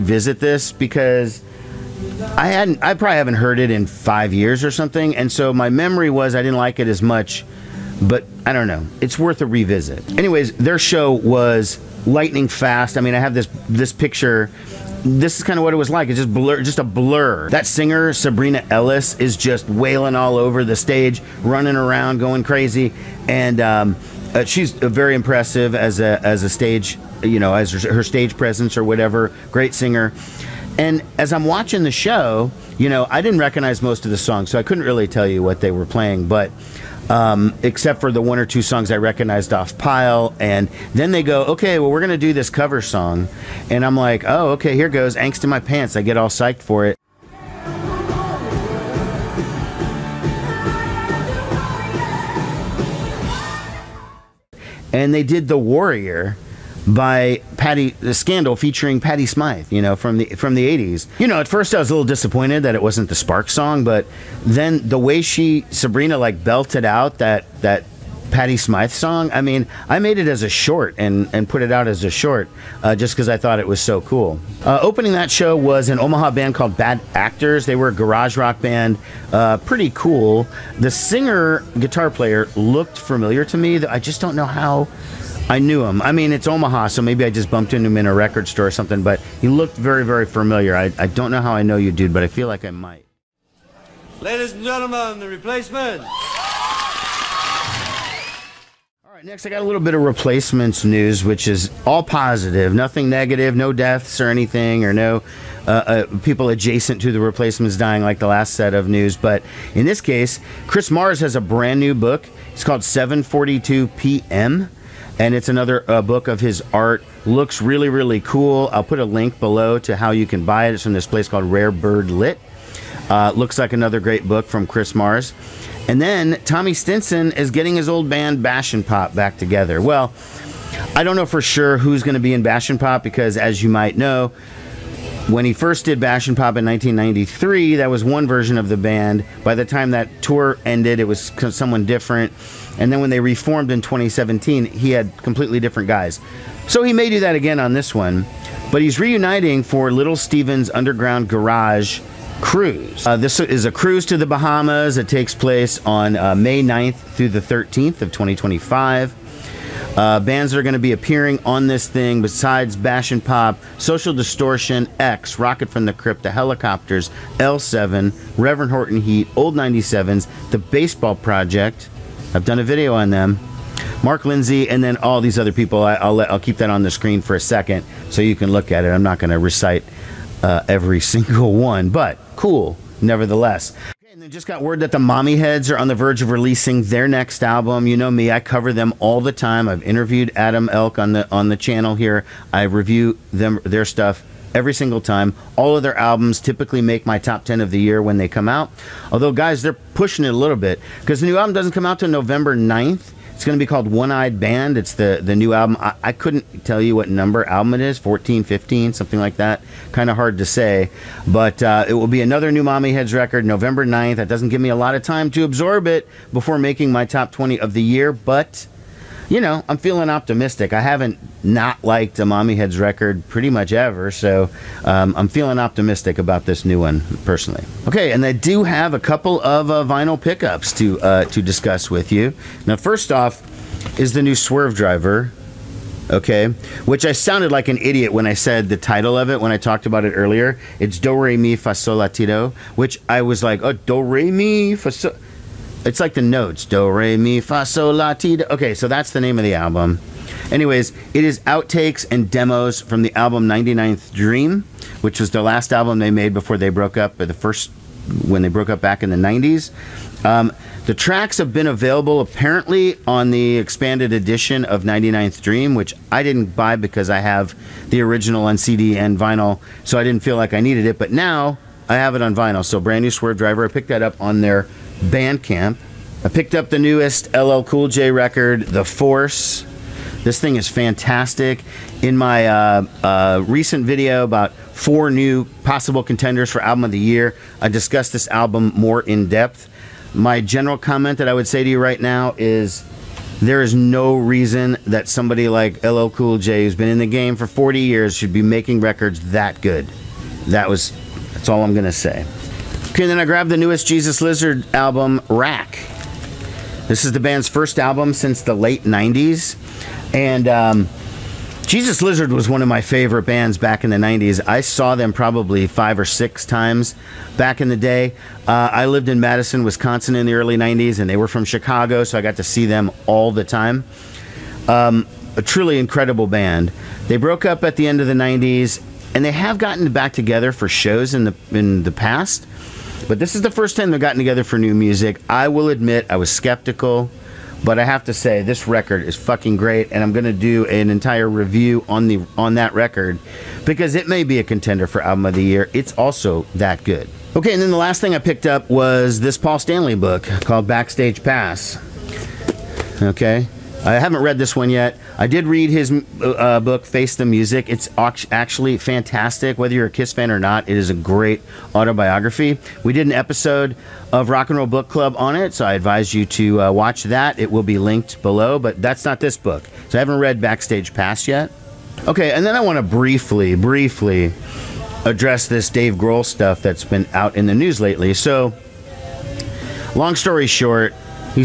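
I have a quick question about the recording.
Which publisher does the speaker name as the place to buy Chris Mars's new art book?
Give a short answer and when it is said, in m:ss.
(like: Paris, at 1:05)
Rare Bird Lit, at 2:01.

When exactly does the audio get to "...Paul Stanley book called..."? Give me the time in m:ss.
5:49.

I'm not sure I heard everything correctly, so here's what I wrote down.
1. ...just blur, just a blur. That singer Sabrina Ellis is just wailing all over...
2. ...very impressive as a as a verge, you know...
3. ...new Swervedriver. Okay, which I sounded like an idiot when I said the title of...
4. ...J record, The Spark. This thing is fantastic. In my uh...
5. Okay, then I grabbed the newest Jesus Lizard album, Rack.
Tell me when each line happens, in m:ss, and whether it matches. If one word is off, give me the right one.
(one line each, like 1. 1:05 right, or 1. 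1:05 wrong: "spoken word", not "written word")
1. 0:16 right
2. 0:24 wrong: "stage", not "verge"
3. 3:54 right
4. 4:37 wrong: "Force", not "Spark"
5. 5:02 right.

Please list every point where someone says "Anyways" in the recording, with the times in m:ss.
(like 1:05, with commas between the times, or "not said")
0:10, 4:10.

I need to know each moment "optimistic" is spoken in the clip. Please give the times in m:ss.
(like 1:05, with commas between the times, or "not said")
3:40, 3:45.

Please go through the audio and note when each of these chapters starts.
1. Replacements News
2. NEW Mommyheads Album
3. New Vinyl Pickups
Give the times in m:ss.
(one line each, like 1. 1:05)
1. 1:33
2. 3:03
3. 3:48.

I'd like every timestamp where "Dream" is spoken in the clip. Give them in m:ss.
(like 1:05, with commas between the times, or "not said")
4:14, 4:25.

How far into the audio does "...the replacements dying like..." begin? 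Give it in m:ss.
1:47.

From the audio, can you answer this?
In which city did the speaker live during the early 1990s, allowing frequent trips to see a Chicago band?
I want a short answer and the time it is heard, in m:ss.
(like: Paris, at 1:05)
Madison, Wisconsin, at 5:19.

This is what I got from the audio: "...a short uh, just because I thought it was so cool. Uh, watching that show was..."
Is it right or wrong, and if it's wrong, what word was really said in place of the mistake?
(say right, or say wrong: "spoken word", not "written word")
wrong: "opening", not "watching".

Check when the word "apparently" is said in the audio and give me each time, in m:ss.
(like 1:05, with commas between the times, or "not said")
4:22.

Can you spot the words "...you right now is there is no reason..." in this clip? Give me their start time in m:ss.
4:51.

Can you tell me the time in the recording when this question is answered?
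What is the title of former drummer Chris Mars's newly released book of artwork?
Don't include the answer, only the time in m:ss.
1:52.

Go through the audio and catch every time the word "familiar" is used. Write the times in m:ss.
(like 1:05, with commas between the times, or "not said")
1:22, 1:30.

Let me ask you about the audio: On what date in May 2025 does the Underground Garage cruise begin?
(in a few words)
May 9.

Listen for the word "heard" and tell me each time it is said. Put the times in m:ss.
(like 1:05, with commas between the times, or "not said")
0:03.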